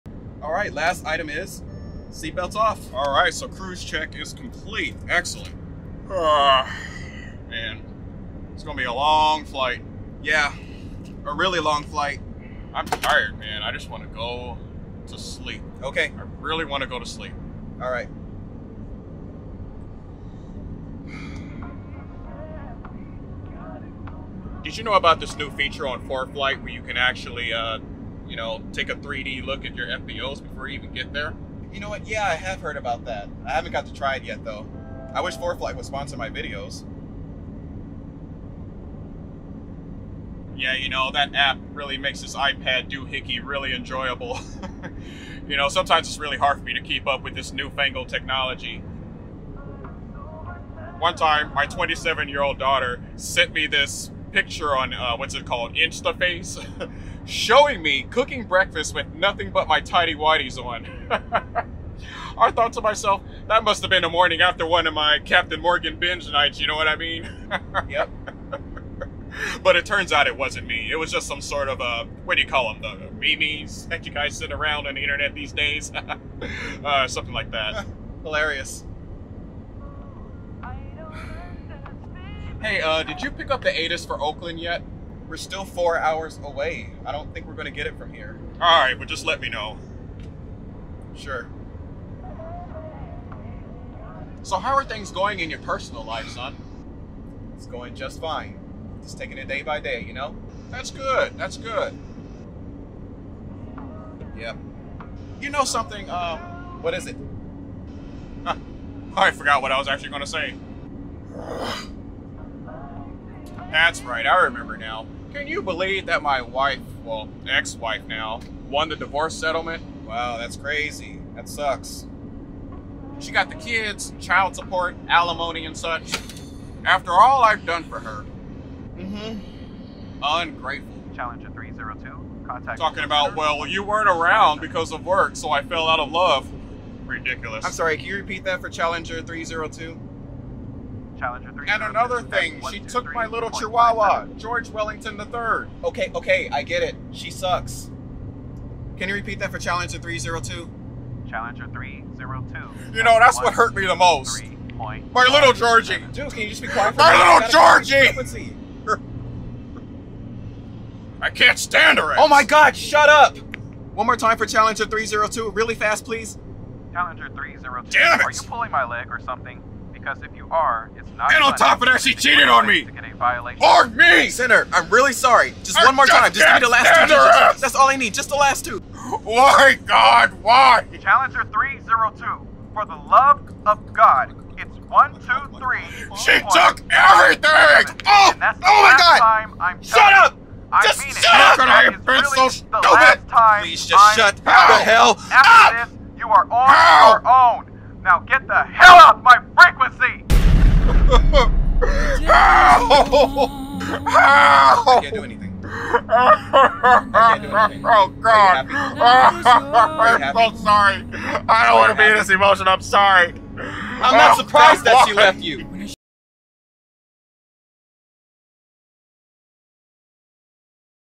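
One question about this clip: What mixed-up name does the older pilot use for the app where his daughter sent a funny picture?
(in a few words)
InstaFace.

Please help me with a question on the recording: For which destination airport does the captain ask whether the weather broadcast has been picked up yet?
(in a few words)
Oakland.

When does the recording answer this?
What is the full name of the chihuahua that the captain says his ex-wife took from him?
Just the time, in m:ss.
2:24.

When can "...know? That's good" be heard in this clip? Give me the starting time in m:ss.
1:40.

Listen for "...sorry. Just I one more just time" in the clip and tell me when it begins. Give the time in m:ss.
2:55.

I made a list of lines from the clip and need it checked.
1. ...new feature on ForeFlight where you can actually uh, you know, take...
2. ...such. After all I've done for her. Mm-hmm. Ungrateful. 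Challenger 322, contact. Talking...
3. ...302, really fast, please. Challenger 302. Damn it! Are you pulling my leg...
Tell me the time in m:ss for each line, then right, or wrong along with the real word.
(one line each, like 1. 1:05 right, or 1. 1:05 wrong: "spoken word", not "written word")
1. 0:25 right
2. 2:05 wrong: "302", not "322"
3. 2:44 right.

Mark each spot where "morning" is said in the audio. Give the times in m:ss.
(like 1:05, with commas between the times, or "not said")
1:04.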